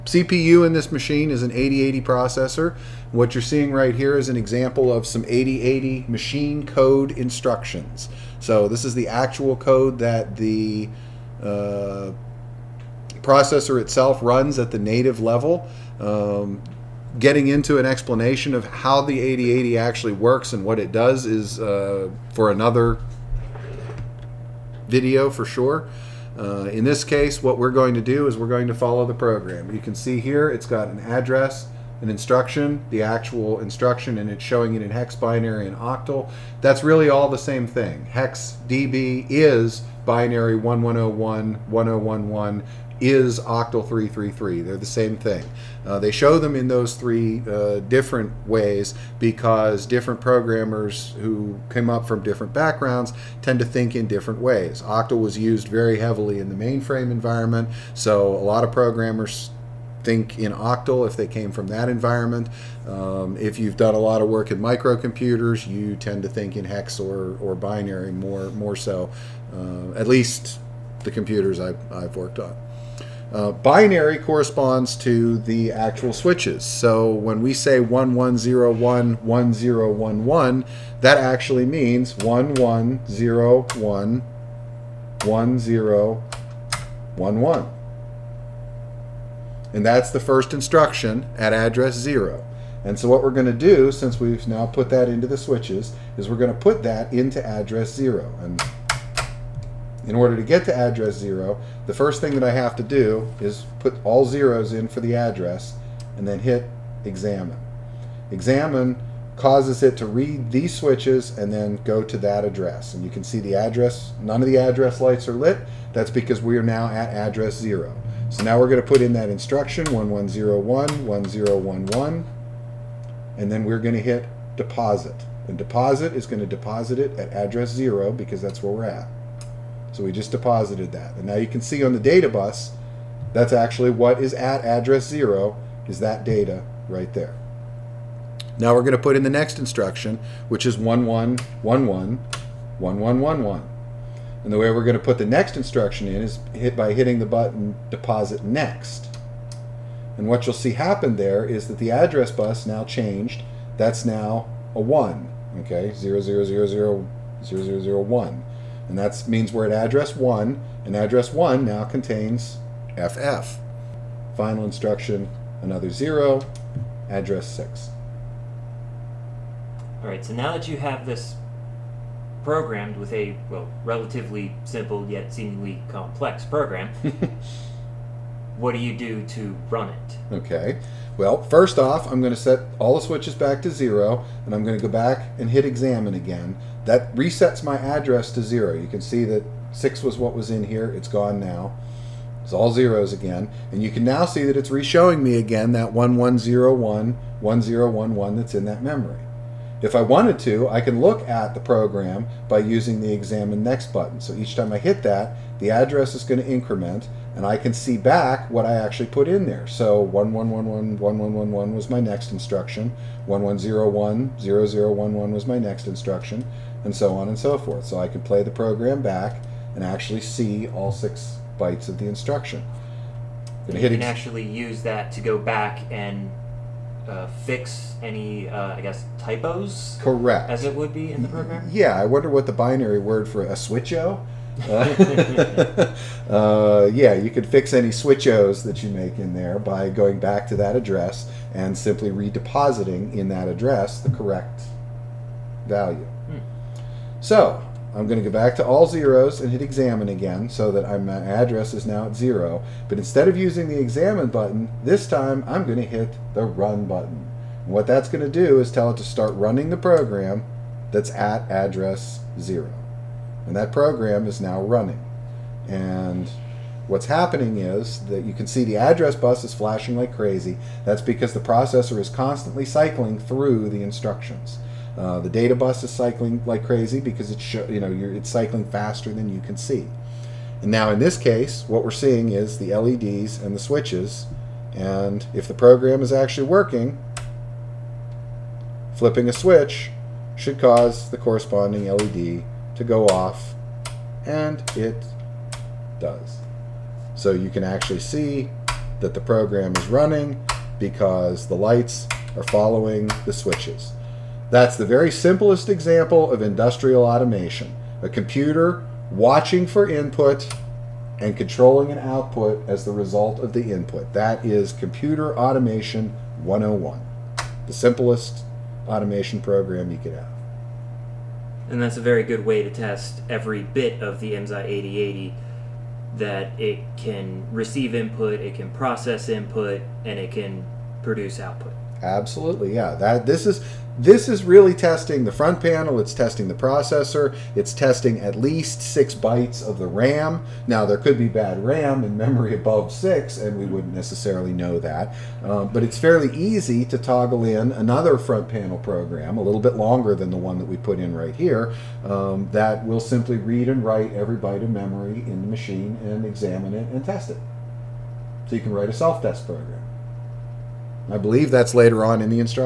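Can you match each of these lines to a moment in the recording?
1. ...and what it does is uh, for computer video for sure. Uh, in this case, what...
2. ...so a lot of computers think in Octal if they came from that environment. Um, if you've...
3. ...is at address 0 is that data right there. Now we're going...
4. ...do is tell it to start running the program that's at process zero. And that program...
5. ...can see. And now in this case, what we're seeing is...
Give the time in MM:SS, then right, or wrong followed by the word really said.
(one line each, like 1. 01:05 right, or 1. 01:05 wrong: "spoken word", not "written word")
1. 00:20 wrong: "another", not "computer"
2. 00:57 wrong: "programmers", not "computers"
3. 02:14 right
4. 04:18 wrong: "address", not "process"
5. 04:39 right.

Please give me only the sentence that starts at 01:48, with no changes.
Examine causes it to read these switches and then go to that address.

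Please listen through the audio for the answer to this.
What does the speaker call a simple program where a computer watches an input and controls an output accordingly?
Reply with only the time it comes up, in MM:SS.
05:06.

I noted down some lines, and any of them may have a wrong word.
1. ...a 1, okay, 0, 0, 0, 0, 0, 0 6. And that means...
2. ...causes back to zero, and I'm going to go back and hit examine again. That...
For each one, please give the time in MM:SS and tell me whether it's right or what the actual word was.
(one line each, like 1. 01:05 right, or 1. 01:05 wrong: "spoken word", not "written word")
1. 02:34 wrong: "1", not "6"
2. 03:03 wrong: "switches", not "causes".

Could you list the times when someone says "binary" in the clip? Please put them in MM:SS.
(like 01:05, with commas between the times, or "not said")
00:35, 00:40, 01:07, 01:13, 03:52.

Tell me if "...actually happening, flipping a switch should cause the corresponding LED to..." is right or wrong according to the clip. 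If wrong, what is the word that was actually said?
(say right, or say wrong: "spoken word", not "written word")
wrong: "working", not "happening".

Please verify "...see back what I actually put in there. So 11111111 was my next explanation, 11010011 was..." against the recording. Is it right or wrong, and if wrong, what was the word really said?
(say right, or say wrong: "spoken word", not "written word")
wrong: "instruction", not "explanation".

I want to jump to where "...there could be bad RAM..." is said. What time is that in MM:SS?
05:40.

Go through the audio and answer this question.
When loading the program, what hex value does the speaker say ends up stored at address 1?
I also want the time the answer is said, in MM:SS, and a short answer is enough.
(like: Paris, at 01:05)
FF, at 02:42.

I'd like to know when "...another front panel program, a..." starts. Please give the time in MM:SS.
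05:47.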